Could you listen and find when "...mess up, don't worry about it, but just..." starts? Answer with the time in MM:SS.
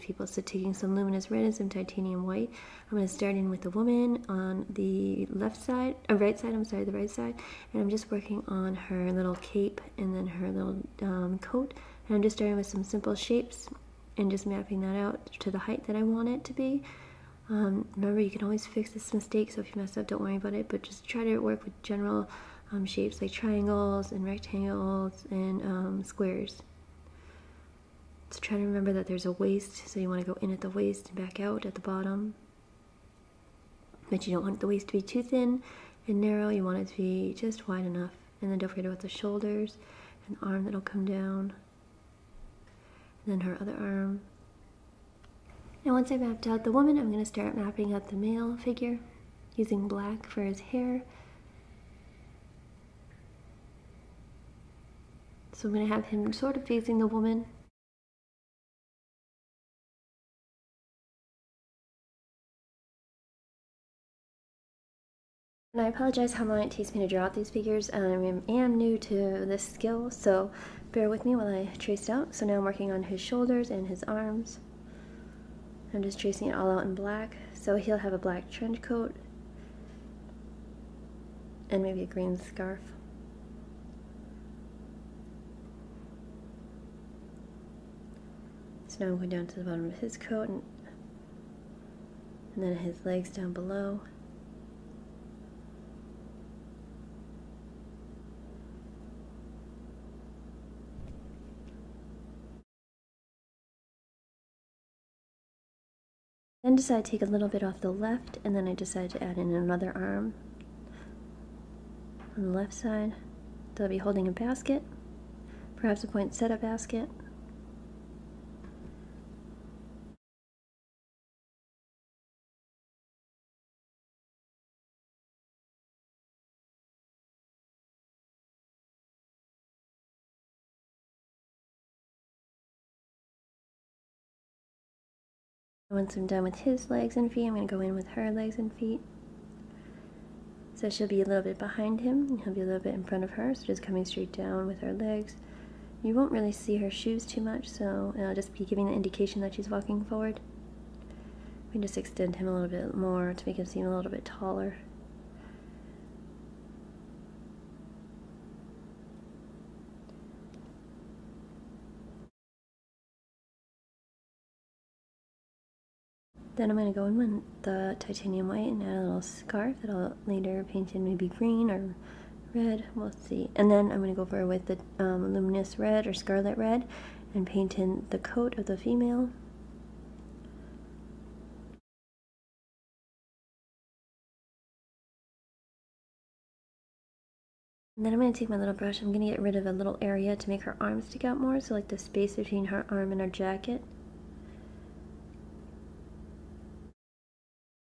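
00:19.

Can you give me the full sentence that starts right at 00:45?
Now once I mapped out the woman, I'm going to start mapping out the male figure using black for his hair.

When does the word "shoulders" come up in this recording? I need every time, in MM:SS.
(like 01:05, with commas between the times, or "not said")
00:39, 01:13.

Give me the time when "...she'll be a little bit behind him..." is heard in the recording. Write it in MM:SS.
02:20.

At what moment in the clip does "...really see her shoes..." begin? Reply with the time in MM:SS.
02:26.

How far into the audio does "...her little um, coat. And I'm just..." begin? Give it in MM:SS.
00:10.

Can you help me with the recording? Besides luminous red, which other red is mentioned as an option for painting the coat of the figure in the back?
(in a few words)
scarlet red.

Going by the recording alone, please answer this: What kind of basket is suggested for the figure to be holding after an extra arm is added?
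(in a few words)
poinsettia basket.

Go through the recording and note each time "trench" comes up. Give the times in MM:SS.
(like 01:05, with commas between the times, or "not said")
01:18.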